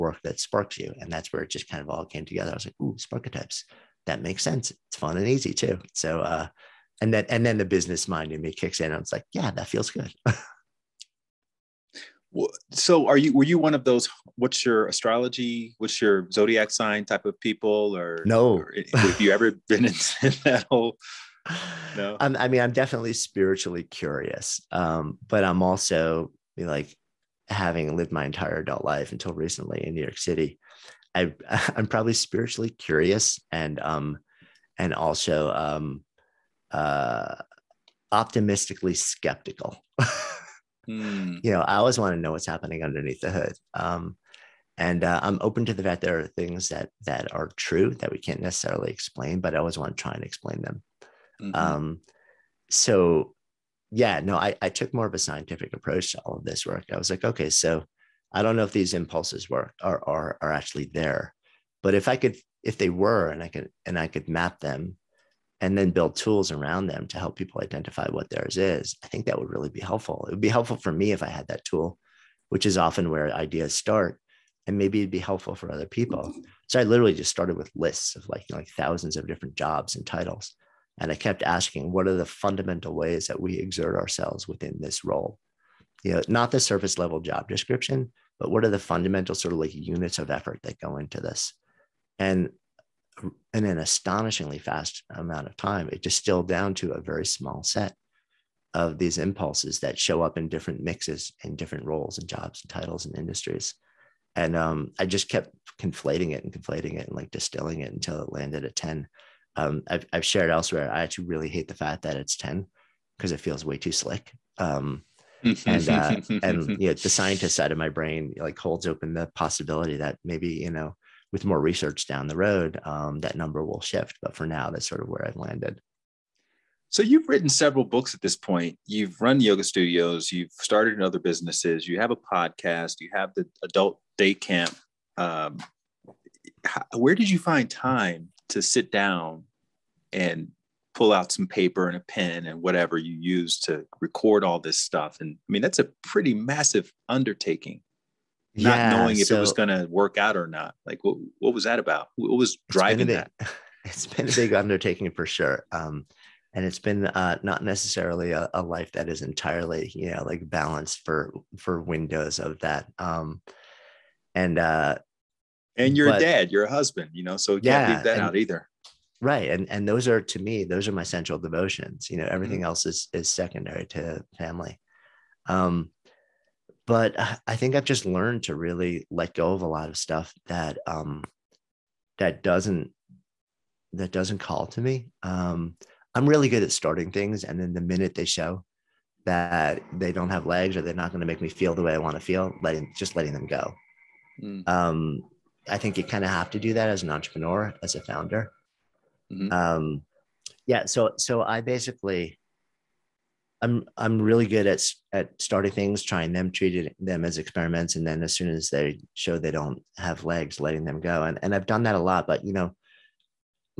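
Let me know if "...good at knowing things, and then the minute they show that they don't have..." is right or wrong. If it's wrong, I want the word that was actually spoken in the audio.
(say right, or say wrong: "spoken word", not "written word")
wrong: "starting", not "knowing".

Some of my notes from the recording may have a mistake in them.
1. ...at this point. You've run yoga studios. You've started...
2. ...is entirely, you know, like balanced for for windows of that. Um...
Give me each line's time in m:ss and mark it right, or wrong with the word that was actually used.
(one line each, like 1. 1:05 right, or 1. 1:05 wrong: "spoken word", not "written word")
1. 2:08 right
2. 2:39 right.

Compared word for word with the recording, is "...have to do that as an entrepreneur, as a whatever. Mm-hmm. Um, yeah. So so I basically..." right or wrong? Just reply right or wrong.
wrong.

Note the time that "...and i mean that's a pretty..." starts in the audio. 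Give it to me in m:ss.
2:25.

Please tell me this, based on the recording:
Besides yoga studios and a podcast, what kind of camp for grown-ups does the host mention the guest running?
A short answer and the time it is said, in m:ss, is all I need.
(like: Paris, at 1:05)
Adult day camp, at 2:13.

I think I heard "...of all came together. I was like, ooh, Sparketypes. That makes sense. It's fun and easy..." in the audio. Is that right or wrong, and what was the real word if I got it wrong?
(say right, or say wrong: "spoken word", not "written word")
right.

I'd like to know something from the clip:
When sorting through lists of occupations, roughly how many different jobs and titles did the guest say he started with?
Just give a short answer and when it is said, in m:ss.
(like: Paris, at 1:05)
Thousands, at 1:18.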